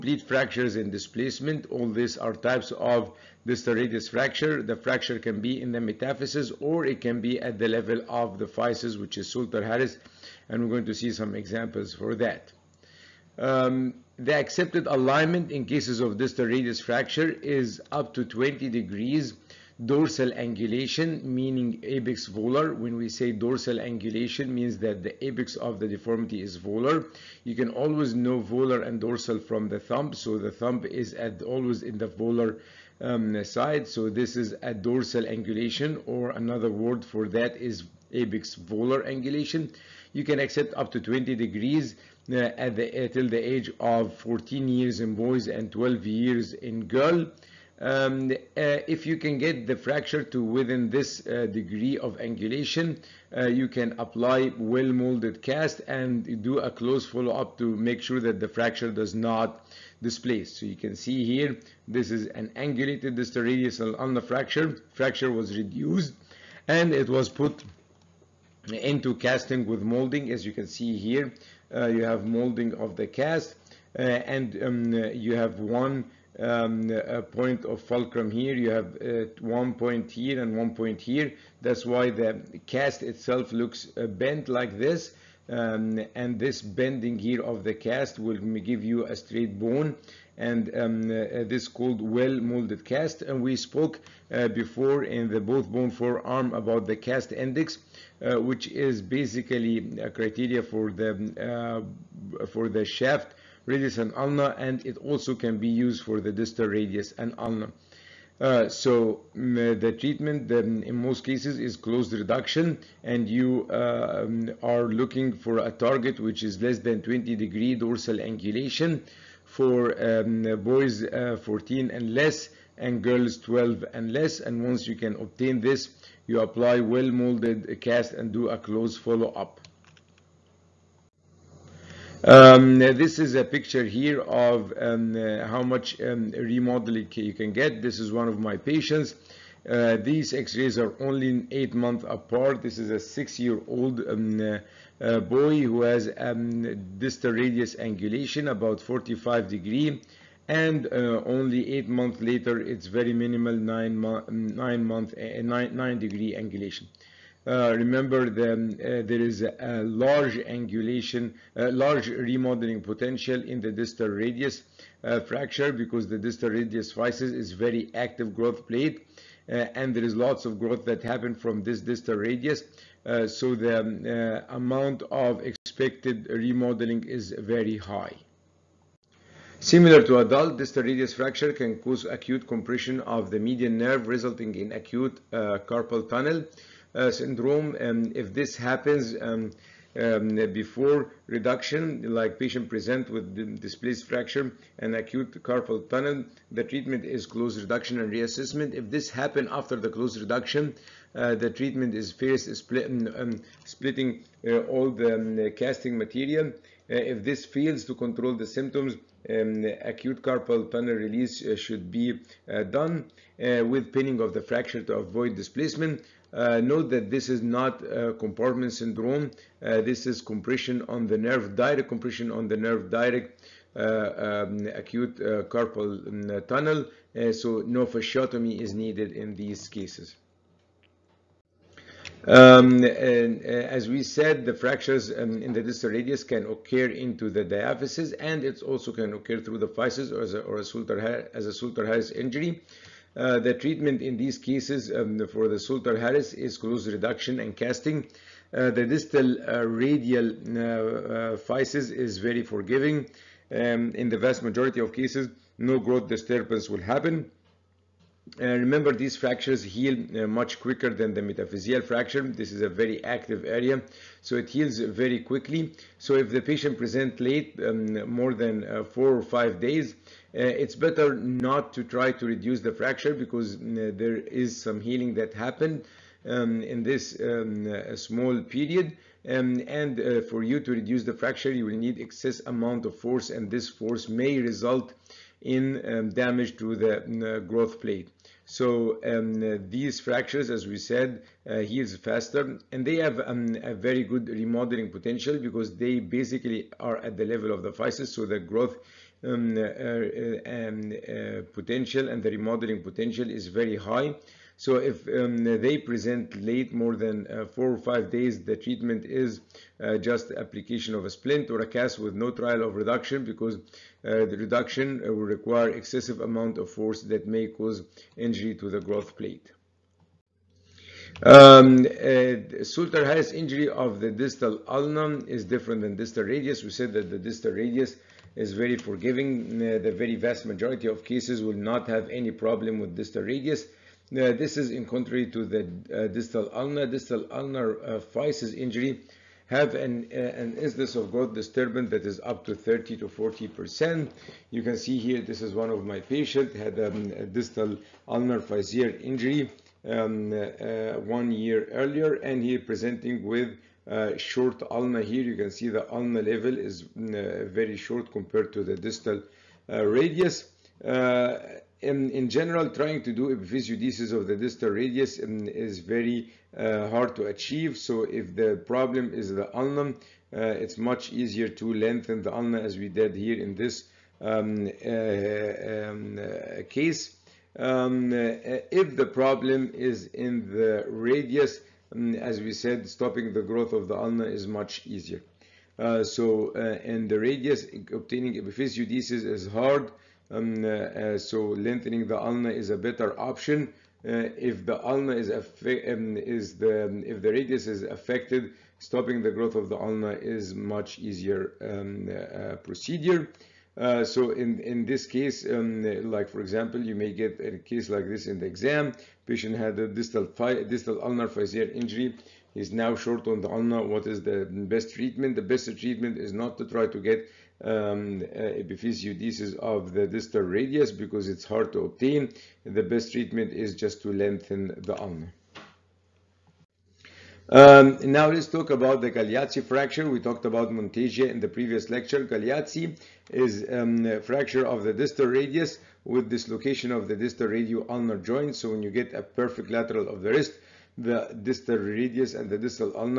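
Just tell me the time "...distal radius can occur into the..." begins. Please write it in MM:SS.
03:55.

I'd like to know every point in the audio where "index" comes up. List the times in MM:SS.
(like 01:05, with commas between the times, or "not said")
01:37.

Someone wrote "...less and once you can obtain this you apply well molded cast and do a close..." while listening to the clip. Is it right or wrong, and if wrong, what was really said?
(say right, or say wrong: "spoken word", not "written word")
right.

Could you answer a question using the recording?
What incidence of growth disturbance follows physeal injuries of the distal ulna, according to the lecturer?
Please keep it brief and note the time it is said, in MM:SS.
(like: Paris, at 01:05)
30 to 40 percent, at 05:42.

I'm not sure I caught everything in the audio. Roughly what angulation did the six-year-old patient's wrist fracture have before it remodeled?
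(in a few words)
45 degrees.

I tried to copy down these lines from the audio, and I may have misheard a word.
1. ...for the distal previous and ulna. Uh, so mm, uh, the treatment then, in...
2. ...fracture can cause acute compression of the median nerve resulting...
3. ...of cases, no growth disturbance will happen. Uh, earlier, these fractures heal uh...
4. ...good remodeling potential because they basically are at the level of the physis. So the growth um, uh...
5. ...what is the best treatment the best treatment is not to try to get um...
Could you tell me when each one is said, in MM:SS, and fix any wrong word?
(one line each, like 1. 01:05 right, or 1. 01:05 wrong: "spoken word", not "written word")
1. 01:46 wrong: "radius", not "previous"
2. 03:01 right
3. 04:14 wrong: "remember", not "earlier"
4. 04:54 right
5. 06:53 right.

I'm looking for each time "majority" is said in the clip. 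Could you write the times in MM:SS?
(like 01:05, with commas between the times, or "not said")
04:14, 05:30.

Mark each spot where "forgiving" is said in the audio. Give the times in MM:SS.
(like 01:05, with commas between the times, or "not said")
04:12, 05:28.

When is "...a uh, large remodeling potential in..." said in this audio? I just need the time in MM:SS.
02:41.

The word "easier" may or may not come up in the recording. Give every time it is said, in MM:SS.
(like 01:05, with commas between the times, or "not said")
06:11, 06:24, 06:41.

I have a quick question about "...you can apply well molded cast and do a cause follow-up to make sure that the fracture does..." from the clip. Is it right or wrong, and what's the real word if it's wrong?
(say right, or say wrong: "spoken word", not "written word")
wrong: "close", not "cause".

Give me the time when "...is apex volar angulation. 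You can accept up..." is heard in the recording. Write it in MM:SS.
00:37.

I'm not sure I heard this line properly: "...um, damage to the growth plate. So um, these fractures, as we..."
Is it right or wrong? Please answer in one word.
right.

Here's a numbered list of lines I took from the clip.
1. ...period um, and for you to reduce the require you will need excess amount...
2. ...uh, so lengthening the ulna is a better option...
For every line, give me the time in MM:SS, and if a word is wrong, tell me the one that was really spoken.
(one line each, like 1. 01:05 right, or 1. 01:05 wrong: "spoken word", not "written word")
1. 04:38 wrong: "fracture", not "require"
2. 06:30 right.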